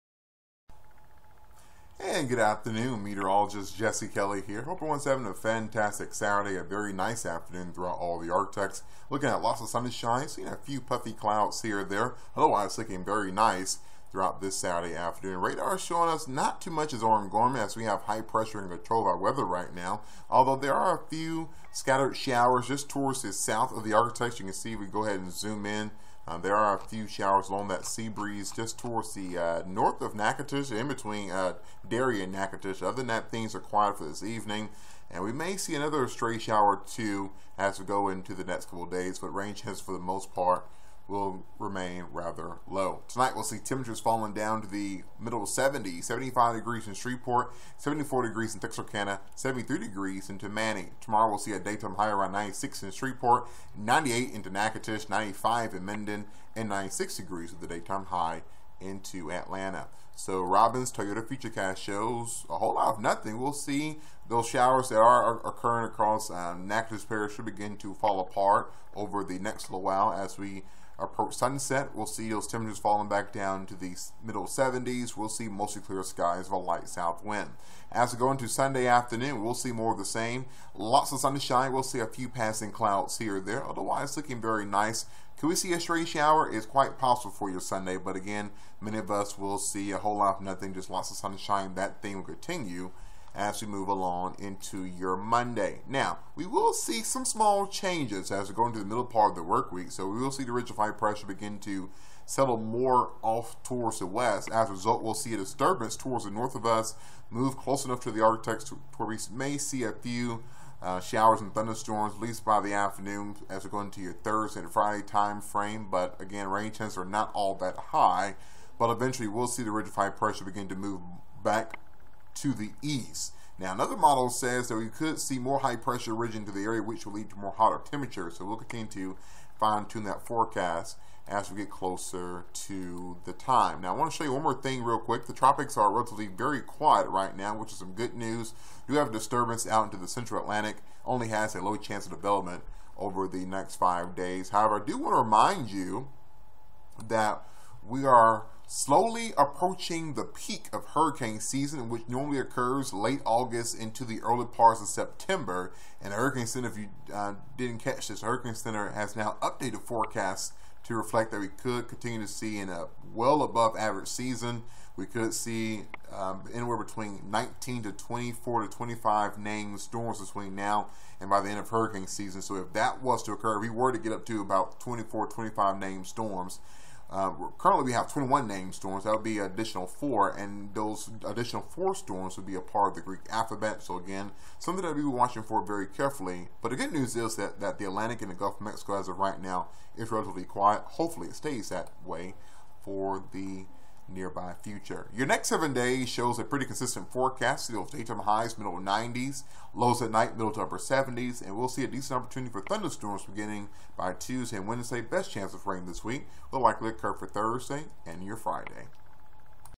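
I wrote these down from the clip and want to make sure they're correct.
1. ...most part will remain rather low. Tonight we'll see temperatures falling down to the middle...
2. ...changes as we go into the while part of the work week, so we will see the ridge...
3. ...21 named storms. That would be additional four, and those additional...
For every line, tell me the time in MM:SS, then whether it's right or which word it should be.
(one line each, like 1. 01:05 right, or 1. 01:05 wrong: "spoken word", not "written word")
1. 00:39 right
2. 01:37 wrong: "middle", not "while"
3. 02:58 right.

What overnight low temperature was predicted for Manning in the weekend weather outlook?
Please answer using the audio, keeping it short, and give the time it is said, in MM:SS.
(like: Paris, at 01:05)
73 degrees, at 00:49.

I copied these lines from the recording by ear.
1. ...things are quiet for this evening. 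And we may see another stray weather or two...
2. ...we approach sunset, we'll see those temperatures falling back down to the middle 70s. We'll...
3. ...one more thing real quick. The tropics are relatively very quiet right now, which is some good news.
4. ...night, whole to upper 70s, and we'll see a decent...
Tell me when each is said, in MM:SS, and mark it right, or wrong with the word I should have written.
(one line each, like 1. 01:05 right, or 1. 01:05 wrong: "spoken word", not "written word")
1. 00:33 wrong: "shower", not "weather"
2. 01:10 right
3. 02:14 right
4. 03:20 wrong: "middle", not "whole".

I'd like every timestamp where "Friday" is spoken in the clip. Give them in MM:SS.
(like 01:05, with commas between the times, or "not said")
01:54, 03:28.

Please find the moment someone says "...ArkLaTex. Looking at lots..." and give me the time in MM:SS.
00:08.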